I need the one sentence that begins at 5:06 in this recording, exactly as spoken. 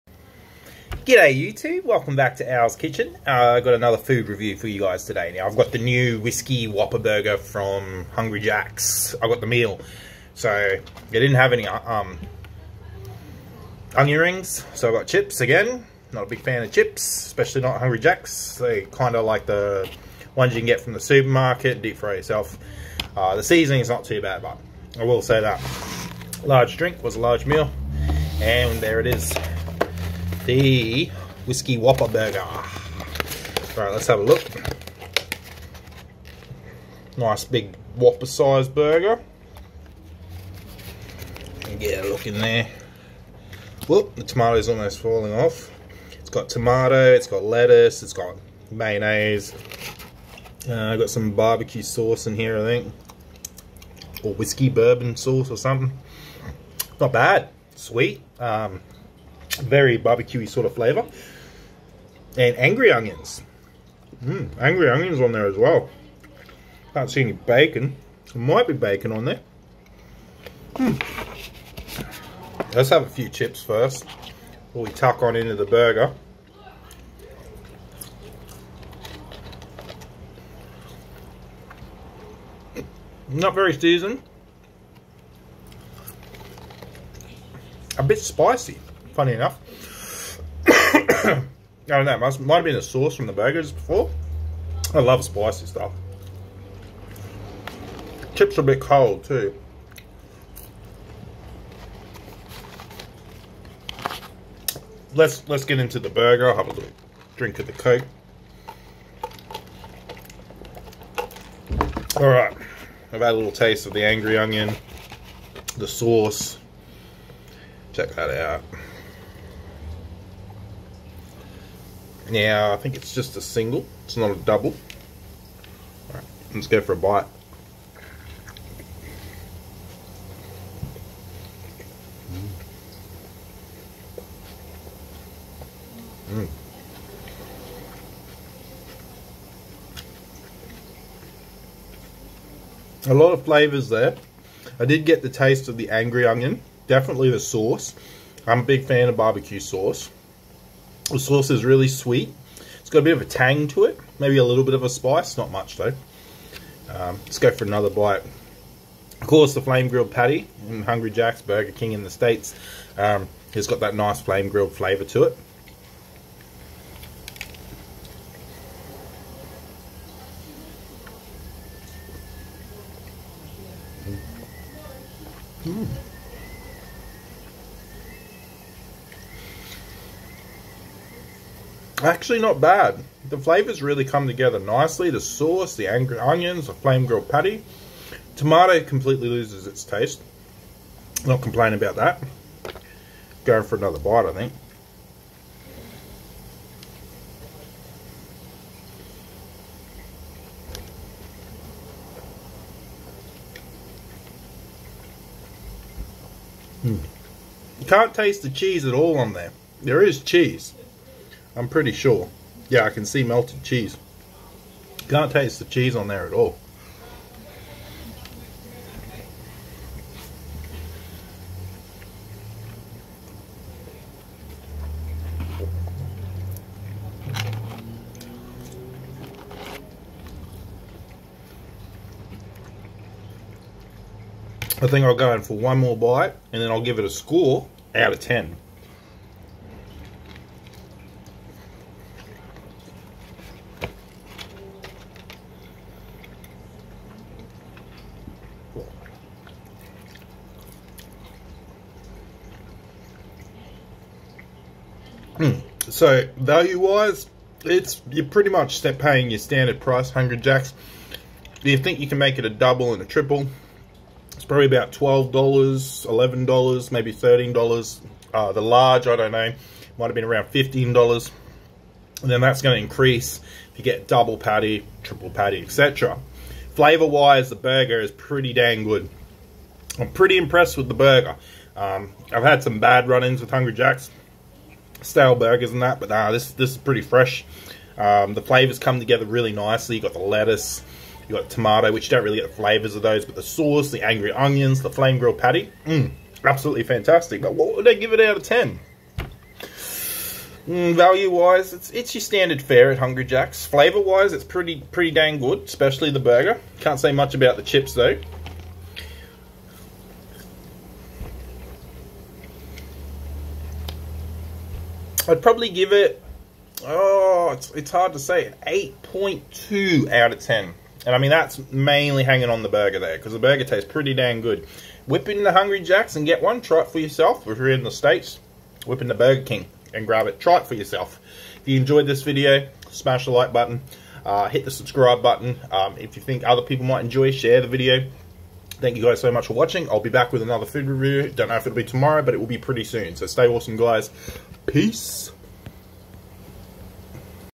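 Can't say much about the chips, though.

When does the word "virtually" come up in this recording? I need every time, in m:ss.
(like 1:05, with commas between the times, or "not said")
not said.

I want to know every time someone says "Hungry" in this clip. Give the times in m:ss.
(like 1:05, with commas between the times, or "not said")
0:08, 0:17, 2:40, 4:20, 4:43, 5:02, 5:25.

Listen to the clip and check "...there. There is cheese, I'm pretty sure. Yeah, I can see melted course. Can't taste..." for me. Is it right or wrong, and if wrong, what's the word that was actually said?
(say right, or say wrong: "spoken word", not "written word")
wrong: "cheese", not "course".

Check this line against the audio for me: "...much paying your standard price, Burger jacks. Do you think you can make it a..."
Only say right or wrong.
wrong.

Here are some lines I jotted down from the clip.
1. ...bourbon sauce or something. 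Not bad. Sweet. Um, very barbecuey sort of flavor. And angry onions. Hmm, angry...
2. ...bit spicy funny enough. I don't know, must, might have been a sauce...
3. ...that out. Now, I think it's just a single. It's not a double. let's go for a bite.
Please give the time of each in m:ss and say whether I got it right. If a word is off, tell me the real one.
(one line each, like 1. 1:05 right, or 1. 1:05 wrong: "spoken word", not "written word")
1. 0:54 right
2. 1:28 right
3. 1:58 right.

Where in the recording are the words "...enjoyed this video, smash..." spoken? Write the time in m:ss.
5:31.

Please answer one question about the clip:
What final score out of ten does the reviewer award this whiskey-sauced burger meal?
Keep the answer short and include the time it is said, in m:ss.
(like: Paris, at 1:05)
8.2, at 5:18.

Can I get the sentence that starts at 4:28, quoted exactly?
Uh, the large, I don't know, might have been around fifteen dollars.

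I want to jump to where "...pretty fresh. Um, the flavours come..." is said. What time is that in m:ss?
4:46.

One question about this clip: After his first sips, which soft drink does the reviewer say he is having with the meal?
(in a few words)
coke.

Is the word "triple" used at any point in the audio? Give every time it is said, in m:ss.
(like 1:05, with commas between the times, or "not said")
4:23, 4:35.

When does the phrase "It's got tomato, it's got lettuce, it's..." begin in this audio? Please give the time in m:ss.
0:46.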